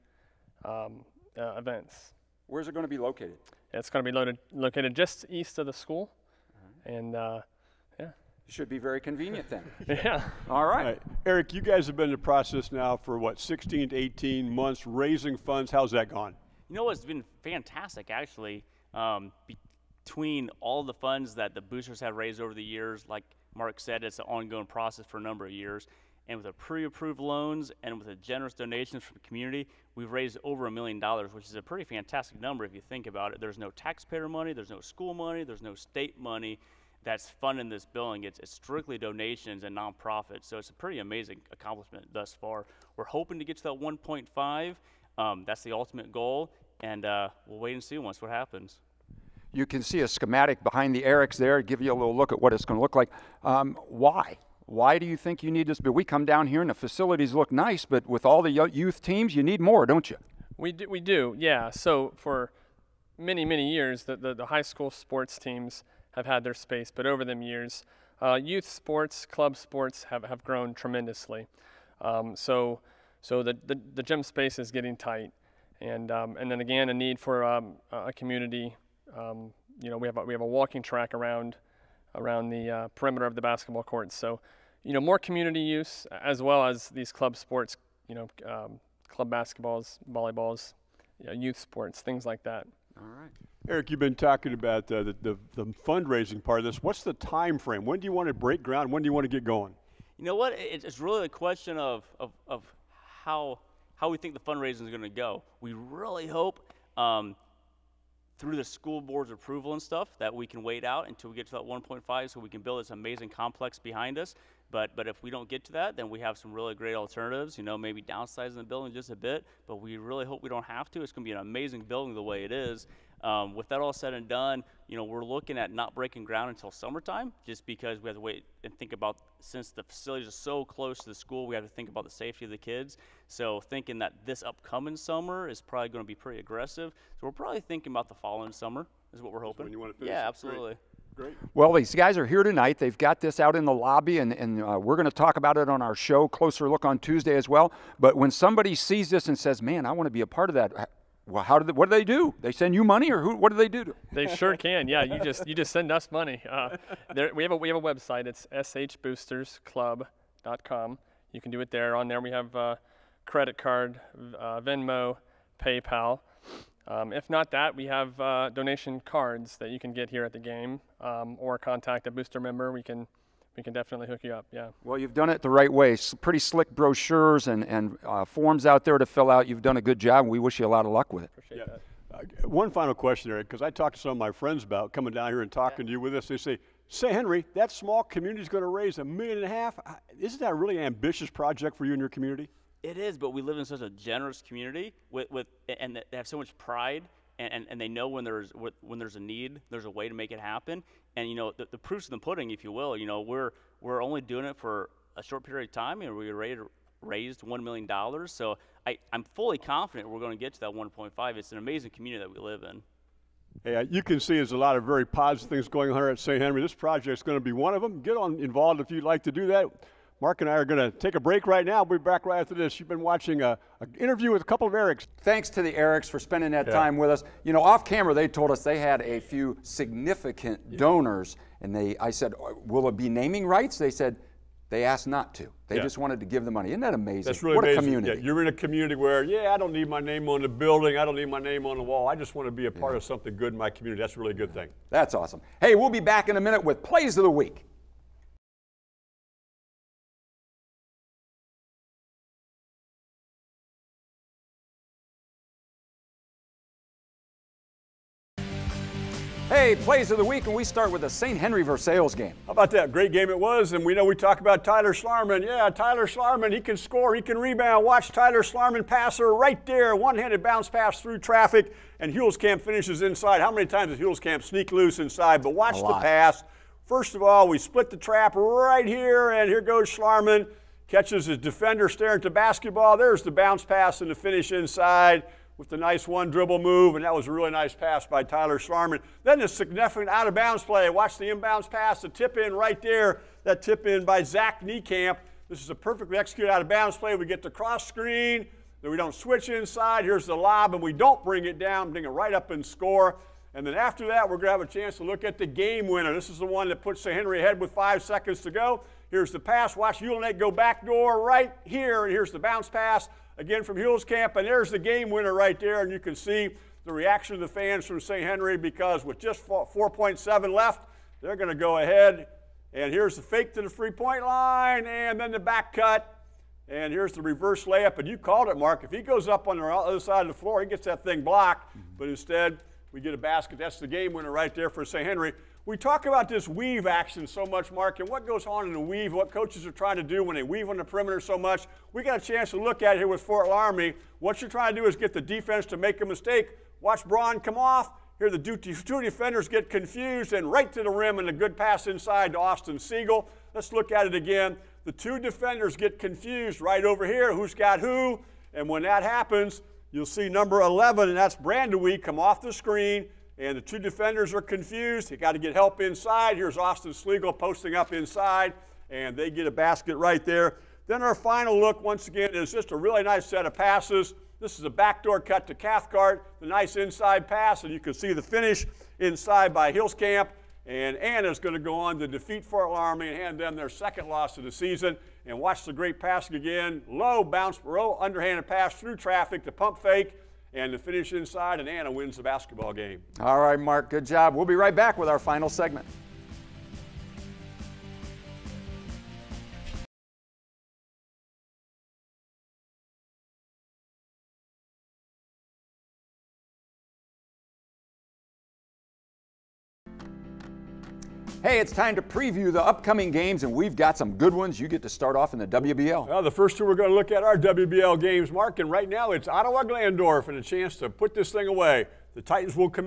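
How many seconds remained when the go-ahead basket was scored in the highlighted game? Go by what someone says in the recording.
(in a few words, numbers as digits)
4.7.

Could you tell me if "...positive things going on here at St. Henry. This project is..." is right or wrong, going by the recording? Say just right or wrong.
right.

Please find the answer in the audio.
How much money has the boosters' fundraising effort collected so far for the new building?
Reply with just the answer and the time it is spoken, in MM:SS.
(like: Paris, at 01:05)
a million dollars, at 00:30.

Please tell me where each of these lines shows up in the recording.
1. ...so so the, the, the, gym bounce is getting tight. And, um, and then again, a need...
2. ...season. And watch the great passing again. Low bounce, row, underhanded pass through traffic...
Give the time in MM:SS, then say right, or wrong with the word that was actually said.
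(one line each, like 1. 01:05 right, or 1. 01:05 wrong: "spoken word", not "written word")
1. 01:12 wrong: "space", not "bounce"
2. 06:24 right.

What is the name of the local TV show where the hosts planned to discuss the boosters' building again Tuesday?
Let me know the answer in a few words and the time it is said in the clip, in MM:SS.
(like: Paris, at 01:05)
Closer Look, at 02:26.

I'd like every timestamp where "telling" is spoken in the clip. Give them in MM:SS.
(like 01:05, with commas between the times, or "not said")
not said.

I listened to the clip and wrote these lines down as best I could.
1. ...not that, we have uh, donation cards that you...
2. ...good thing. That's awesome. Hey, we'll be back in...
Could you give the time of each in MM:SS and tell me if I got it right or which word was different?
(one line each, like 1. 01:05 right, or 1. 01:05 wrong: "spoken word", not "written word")
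1. 02:47 right
2. 04:04 right.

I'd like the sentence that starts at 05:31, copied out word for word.
But instead, we get a basket.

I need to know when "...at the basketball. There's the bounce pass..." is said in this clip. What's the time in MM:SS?
04:42.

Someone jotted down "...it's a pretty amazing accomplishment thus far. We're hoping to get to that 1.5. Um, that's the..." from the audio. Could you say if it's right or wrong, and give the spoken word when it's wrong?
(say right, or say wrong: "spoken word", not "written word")
right.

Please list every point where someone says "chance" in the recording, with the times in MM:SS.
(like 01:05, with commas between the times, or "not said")
05:04, 05:42, 07:00.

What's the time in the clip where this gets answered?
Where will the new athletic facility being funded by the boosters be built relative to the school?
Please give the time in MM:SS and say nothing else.
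00:04.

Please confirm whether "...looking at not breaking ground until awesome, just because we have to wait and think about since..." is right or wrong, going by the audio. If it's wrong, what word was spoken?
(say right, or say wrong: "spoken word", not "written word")
wrong: "summertime", not "awesome".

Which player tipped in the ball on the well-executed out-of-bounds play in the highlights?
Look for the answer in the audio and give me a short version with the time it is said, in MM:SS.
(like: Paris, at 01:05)
Zach Niekamp, at 04:54.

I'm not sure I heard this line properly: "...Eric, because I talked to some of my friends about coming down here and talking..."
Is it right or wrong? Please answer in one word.
right.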